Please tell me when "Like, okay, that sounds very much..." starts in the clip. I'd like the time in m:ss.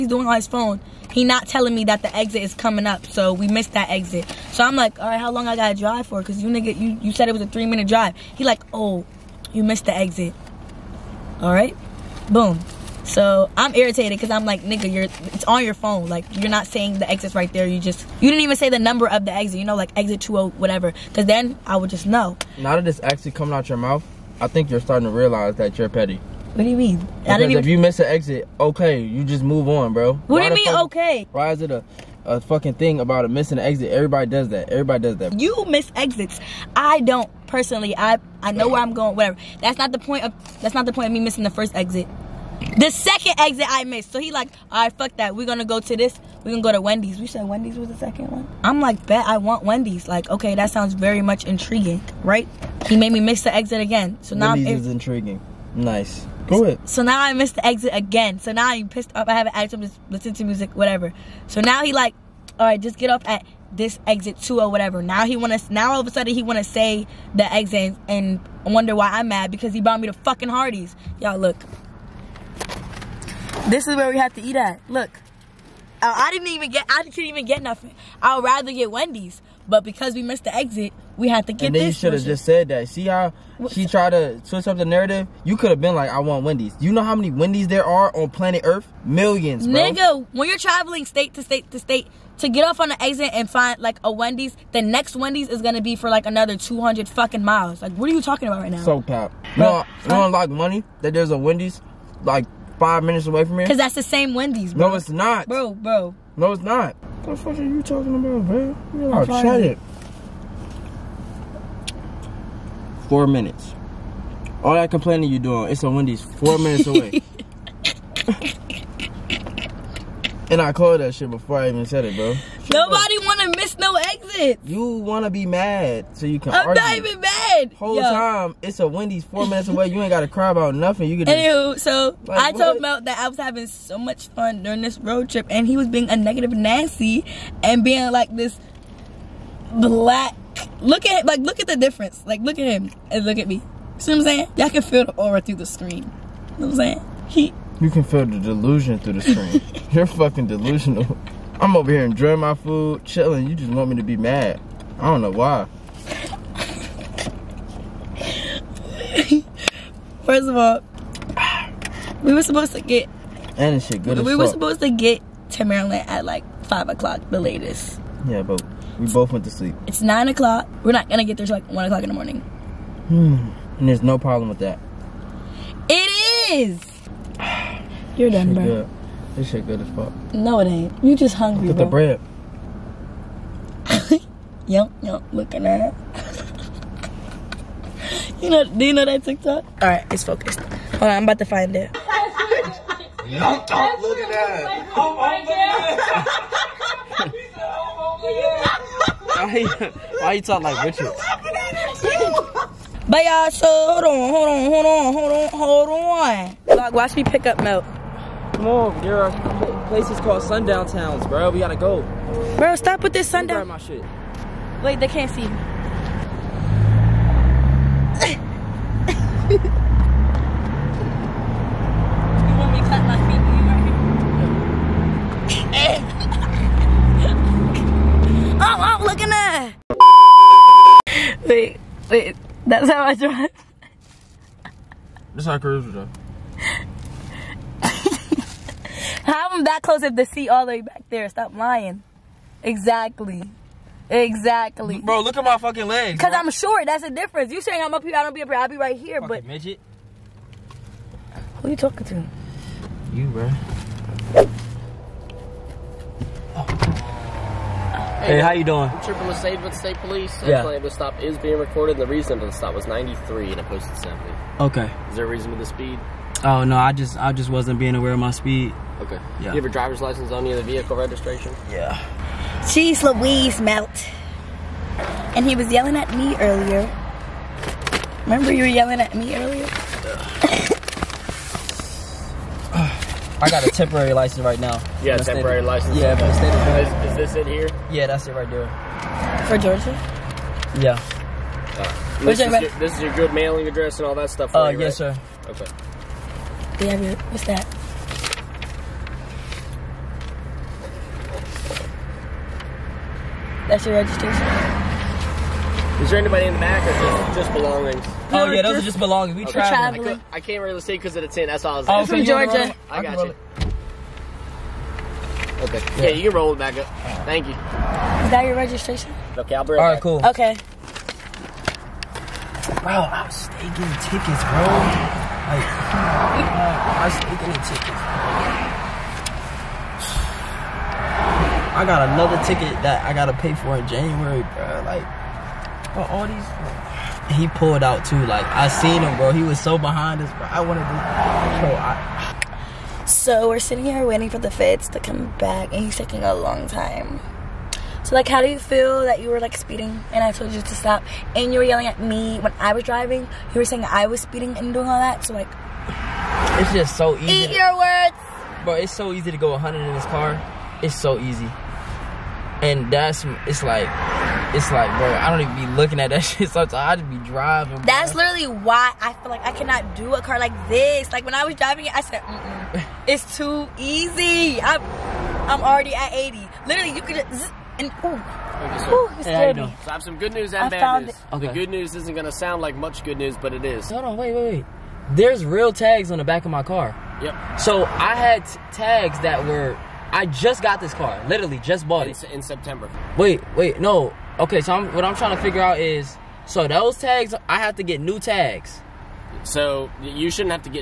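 0:50.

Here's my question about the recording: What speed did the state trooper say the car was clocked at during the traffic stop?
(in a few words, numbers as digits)
93.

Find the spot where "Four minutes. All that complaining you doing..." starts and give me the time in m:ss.
1:53.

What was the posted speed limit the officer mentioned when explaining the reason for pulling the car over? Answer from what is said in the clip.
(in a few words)
70.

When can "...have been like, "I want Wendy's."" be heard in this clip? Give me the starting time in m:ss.
1:25.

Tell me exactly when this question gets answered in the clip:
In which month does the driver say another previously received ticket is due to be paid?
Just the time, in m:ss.
5:33.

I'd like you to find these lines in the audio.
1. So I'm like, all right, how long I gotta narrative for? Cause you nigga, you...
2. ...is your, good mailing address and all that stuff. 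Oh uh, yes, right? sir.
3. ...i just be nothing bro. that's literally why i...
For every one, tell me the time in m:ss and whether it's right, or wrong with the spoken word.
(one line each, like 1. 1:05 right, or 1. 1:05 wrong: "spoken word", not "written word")
1. 0:04 wrong: "drive", not "narrative"
2. 4:52 right
3. 6:06 wrong: "driving", not "nothing".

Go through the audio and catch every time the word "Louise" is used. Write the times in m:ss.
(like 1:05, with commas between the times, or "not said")
4:33.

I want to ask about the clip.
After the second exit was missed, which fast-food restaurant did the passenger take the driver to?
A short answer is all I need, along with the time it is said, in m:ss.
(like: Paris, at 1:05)
Hardee's, at 1:10.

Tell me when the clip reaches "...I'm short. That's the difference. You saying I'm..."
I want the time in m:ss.
4:06.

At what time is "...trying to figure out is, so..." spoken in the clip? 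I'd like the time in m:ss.
6:35.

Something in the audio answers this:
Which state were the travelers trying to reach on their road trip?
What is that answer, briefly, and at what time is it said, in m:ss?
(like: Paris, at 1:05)
Maryland, at 2:45.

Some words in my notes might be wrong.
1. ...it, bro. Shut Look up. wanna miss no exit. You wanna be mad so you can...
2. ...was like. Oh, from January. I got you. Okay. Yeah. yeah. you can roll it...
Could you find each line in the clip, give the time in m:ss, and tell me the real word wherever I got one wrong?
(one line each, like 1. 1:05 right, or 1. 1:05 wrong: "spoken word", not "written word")
1. 2:02 wrong: "Nobody", not "Look"
2. 5:11 wrong: "Georgia", not "January".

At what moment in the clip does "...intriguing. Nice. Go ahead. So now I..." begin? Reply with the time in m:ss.
0:54.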